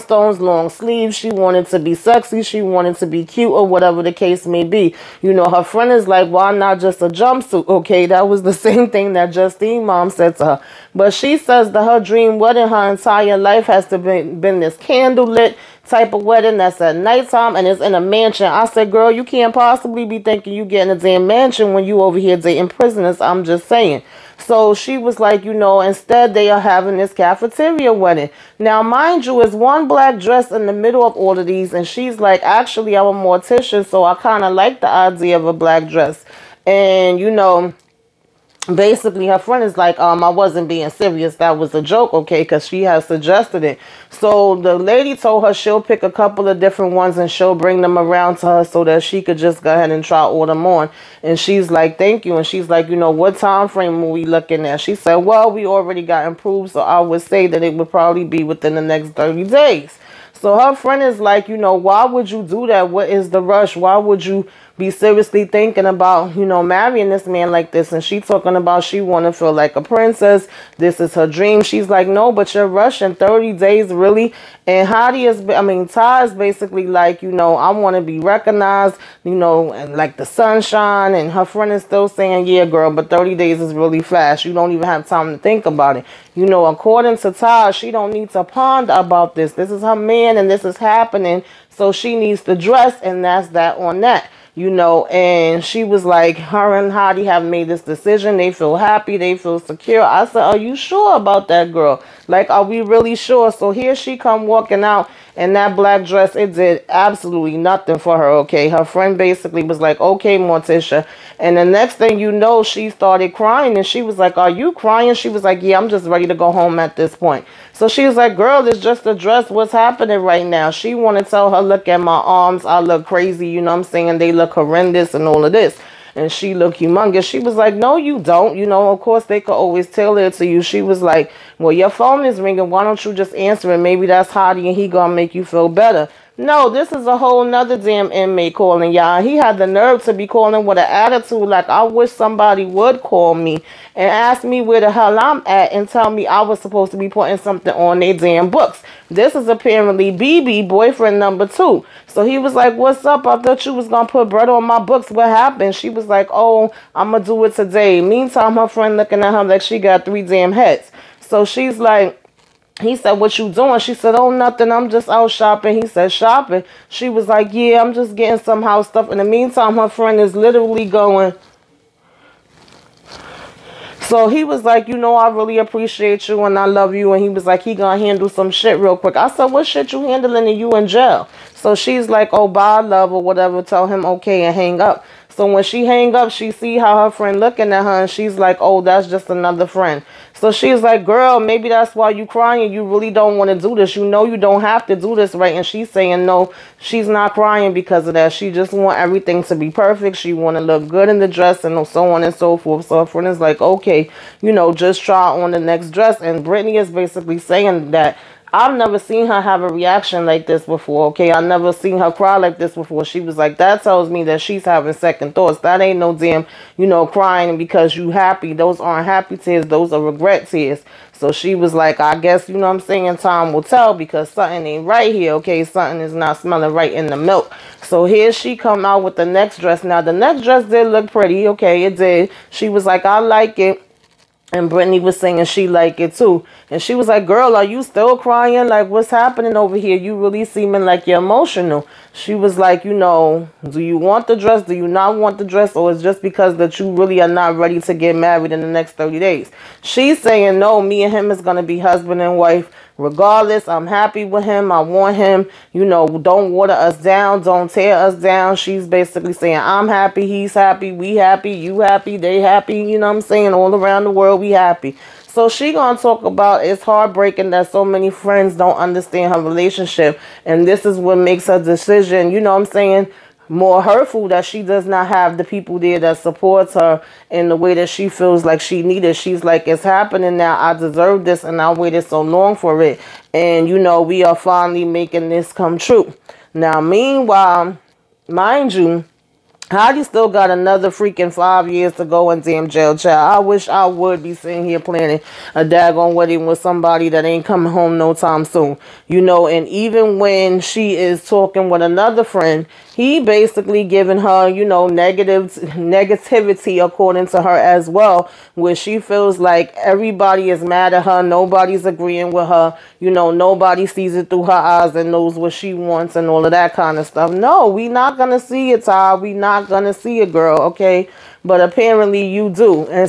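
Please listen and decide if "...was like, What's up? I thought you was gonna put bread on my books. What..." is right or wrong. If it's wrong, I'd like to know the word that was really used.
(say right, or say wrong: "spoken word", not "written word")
right.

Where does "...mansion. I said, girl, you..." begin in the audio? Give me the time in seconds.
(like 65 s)
18 s.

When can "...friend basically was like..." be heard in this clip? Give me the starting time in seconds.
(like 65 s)
108 s.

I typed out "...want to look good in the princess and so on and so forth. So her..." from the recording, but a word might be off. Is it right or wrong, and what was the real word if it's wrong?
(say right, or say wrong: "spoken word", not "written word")
wrong: "dress", not "princess".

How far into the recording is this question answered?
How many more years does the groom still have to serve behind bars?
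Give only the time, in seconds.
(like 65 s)
291 s.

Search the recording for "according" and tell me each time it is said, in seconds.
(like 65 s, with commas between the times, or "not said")
86 s, 306 s.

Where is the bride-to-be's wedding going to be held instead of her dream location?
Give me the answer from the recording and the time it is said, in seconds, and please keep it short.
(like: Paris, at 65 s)
Cafeteria, at 27 s.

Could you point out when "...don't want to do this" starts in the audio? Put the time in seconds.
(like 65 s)
193 s.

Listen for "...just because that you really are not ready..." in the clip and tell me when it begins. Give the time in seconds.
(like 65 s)
246 s.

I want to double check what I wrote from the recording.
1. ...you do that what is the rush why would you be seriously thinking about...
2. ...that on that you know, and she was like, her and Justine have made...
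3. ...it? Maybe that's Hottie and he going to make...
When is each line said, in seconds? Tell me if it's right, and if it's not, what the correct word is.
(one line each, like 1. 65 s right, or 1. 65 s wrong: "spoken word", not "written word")
1. 62 s right
2. 93 s wrong: "Hottie", not "Justine"
3. 133 s right.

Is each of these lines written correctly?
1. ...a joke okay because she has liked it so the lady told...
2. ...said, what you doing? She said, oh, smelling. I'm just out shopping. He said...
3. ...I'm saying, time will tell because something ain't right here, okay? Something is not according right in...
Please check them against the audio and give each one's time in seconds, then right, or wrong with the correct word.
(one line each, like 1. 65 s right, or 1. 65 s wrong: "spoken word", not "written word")
1. 41 s wrong: "suggested", not "liked"
2. 162 s wrong: "nothing", not "smelling"
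3. 222 s wrong: "smelling", not "according".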